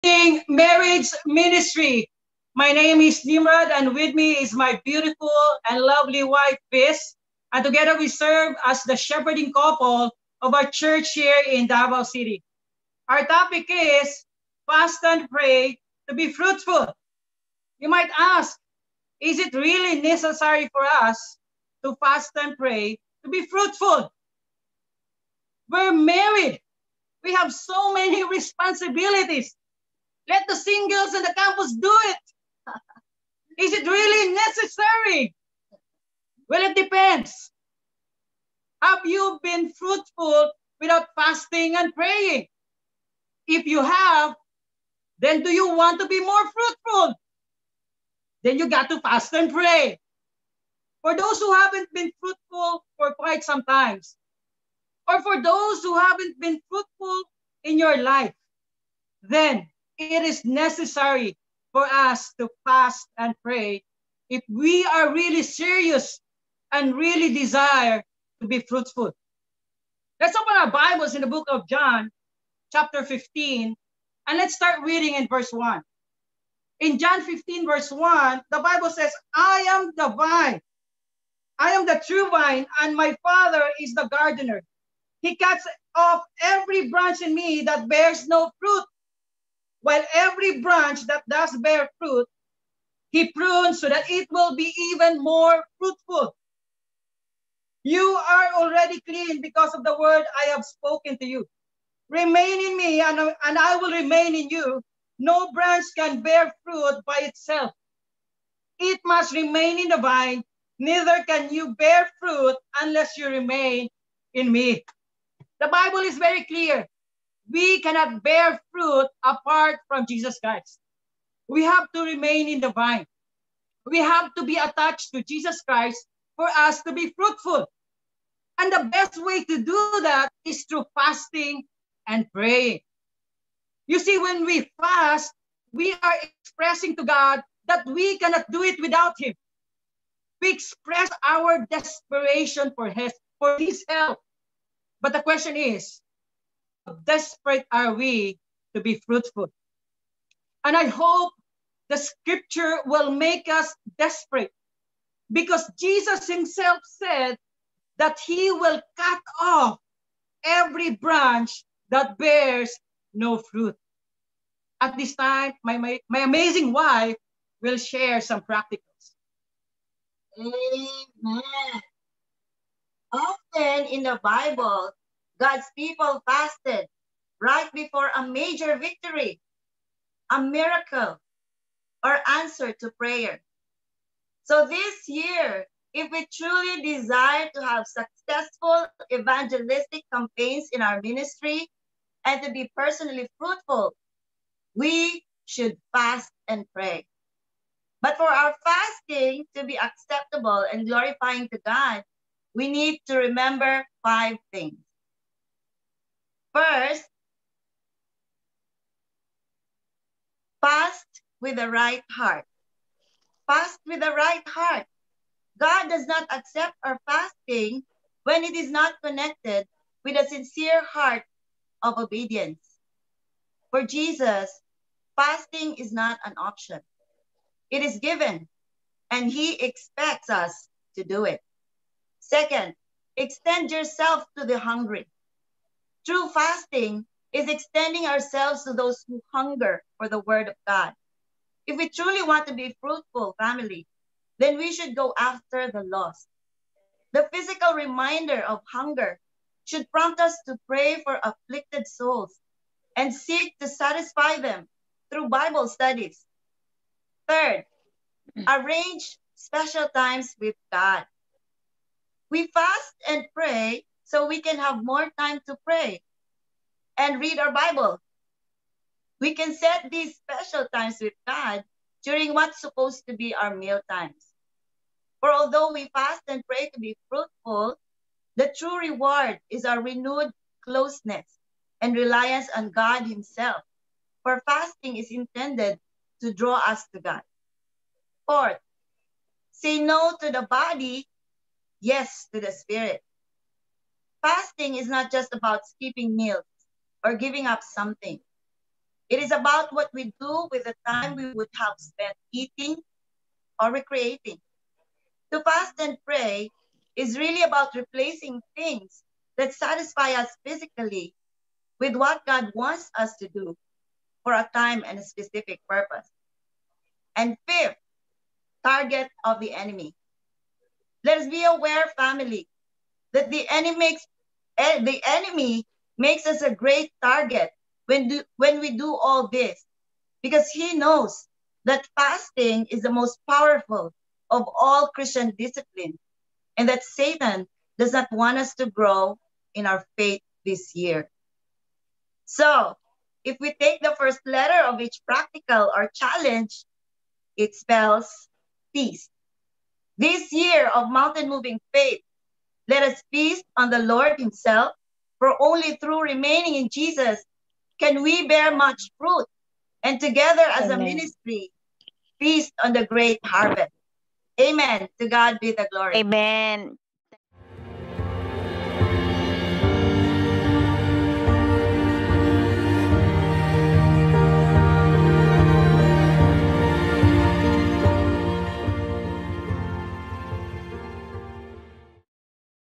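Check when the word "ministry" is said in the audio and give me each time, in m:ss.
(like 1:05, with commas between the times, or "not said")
0:01, 3:11, 6:00.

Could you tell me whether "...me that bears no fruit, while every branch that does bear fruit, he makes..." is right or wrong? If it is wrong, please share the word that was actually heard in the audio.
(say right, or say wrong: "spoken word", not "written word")
wrong: "prunes", not "makes".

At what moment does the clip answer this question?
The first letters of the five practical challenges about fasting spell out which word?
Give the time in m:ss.
5:48.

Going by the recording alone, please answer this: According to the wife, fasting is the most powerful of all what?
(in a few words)
Christian discipline.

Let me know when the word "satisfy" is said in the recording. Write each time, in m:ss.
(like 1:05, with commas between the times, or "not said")
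4:13, 5:09.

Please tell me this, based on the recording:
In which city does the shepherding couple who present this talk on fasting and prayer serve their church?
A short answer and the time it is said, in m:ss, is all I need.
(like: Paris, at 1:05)
Davao City, at 0:11.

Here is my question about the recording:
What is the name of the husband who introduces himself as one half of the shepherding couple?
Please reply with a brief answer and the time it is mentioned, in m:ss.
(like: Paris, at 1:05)
Nimrod, at 0:03.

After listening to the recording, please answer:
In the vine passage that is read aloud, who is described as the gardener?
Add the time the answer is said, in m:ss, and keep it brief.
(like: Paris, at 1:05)
My Father, at 1:22.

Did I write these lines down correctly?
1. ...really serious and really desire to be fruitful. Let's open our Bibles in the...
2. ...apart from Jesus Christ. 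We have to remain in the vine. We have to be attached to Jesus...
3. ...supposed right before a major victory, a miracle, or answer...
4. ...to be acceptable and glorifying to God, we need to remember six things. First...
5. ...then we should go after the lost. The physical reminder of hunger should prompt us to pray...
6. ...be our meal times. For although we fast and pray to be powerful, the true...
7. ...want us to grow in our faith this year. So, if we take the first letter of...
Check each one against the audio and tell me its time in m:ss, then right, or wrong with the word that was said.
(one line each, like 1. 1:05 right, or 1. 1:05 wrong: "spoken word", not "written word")
1. 1:05 right
2. 1:59 right
3. 2:56 wrong: "fasted", not "supposed"
4. 3:19 wrong: "five", not "six"
5. 4:04 right
6. 4:33 wrong: "fruitful", not "powerful"
7. 5:38 right.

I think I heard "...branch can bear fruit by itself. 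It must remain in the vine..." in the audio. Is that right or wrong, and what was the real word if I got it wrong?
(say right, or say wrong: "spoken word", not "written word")
right.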